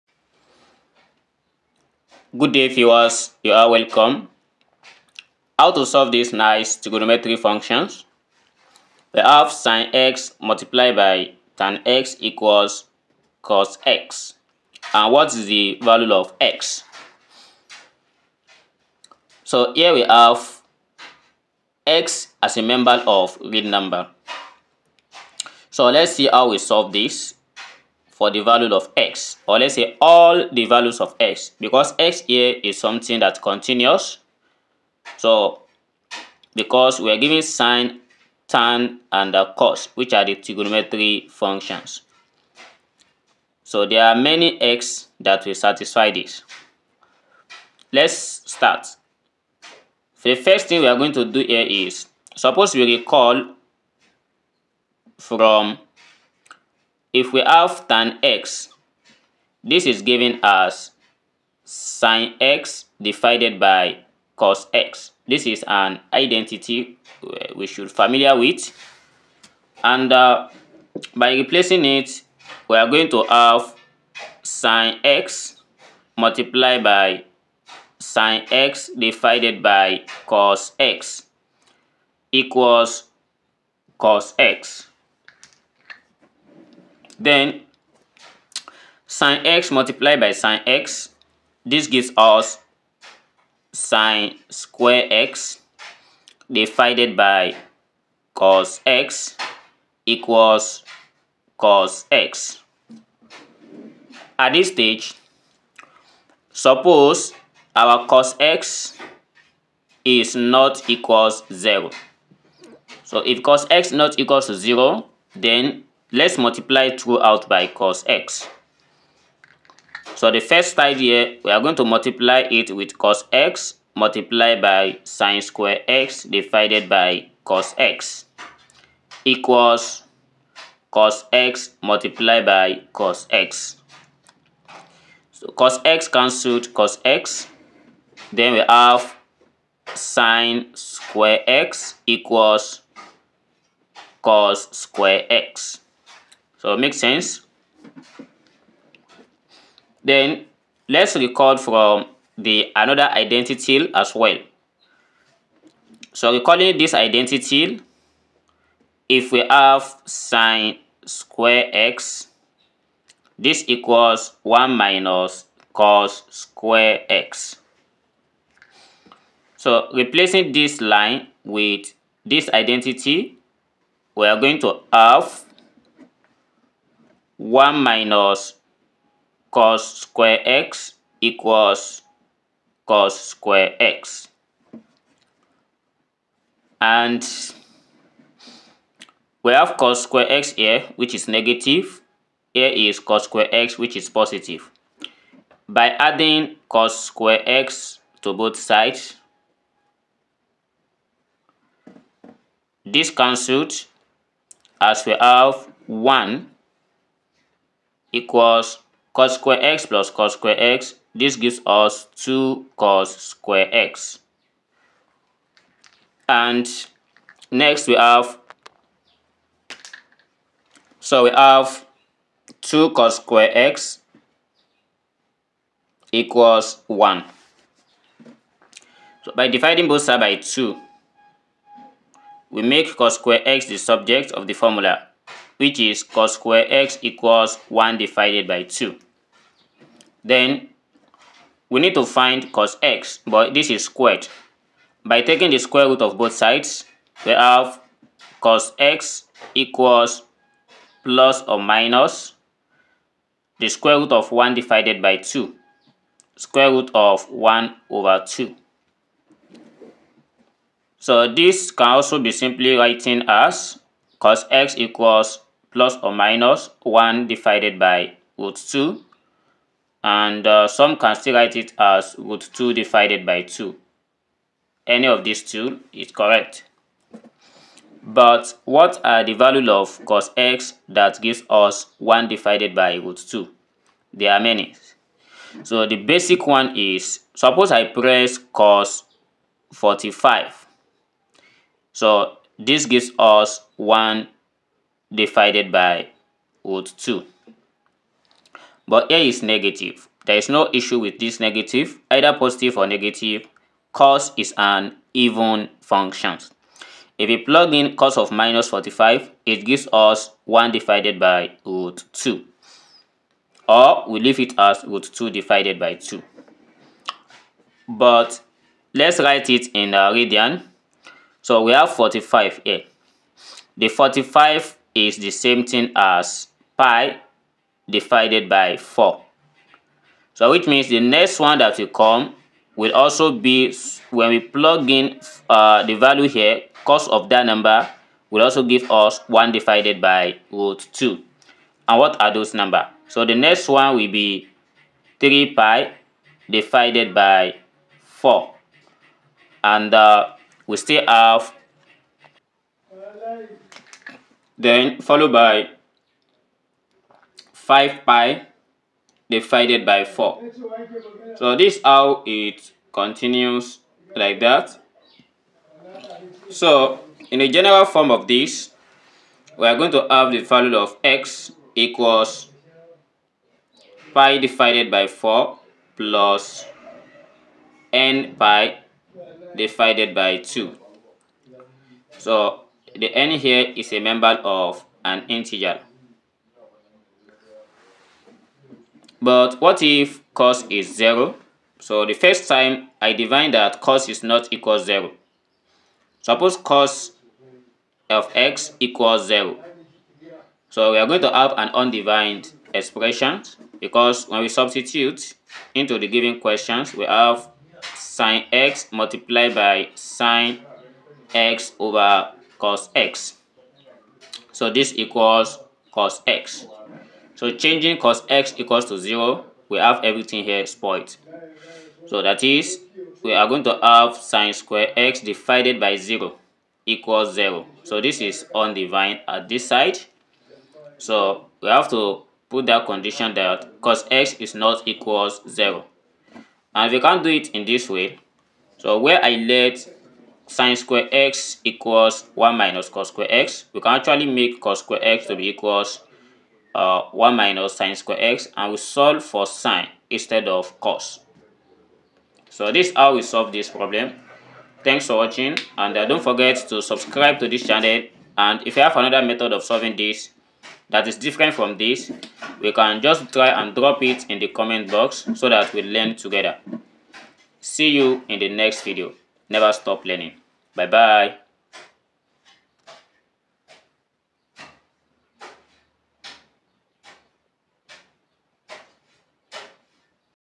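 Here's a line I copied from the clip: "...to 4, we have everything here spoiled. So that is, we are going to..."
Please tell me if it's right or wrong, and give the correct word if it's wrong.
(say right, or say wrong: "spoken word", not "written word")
wrong: "0", not "4".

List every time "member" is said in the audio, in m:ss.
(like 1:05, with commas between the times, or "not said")
0:22, 6:23.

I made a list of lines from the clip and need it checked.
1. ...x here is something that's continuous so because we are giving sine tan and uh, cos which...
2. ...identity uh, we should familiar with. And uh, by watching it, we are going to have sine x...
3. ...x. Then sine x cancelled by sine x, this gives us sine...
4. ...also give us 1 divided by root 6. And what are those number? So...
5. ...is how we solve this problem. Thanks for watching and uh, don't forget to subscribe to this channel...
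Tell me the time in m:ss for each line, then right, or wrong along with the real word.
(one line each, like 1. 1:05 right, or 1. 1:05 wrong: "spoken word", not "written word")
1. 0:31 right
2. 1:06 wrong: "replacing", not "watching"
3. 1:24 wrong: "multiplied", not "cancelled"
4. 5:38 wrong: "2", not "6"
5. 7:32 right.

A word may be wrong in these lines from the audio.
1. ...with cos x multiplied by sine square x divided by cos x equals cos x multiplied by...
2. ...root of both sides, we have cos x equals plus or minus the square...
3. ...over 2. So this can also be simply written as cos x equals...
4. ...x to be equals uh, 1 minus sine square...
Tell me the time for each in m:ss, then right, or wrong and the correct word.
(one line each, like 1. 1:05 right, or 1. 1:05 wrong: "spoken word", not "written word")
1. 2:02 right
2. 4:05 right
3. 4:17 right
4. 7:25 right.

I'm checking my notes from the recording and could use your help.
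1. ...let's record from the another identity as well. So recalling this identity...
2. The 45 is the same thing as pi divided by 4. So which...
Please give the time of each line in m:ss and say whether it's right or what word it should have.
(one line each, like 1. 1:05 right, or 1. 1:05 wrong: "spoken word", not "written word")
1. 2:30 right
2. 5:23 right.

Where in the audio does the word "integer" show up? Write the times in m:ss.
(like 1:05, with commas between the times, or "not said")
6:25.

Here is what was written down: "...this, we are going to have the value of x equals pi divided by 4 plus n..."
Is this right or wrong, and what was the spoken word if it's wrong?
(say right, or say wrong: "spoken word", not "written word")
right.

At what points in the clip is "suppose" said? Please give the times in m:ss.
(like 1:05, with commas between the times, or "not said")
0:52, 1:46, 4:47, 6:36.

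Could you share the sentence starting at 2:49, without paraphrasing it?
So replacing this line with this identity, we are going to have 1 minus cos square x equals cos square x.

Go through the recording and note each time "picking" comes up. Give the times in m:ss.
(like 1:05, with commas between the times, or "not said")
not said.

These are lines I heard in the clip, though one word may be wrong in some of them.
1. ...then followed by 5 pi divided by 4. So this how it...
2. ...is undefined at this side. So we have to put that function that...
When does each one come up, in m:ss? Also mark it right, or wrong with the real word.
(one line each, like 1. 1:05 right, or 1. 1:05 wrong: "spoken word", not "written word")
1. 5:54 right
2. 7:08 wrong: "condition", not "function".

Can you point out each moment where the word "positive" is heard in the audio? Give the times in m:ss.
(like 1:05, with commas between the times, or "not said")
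3:14, 5:02.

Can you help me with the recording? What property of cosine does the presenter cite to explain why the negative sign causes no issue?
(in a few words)
even function.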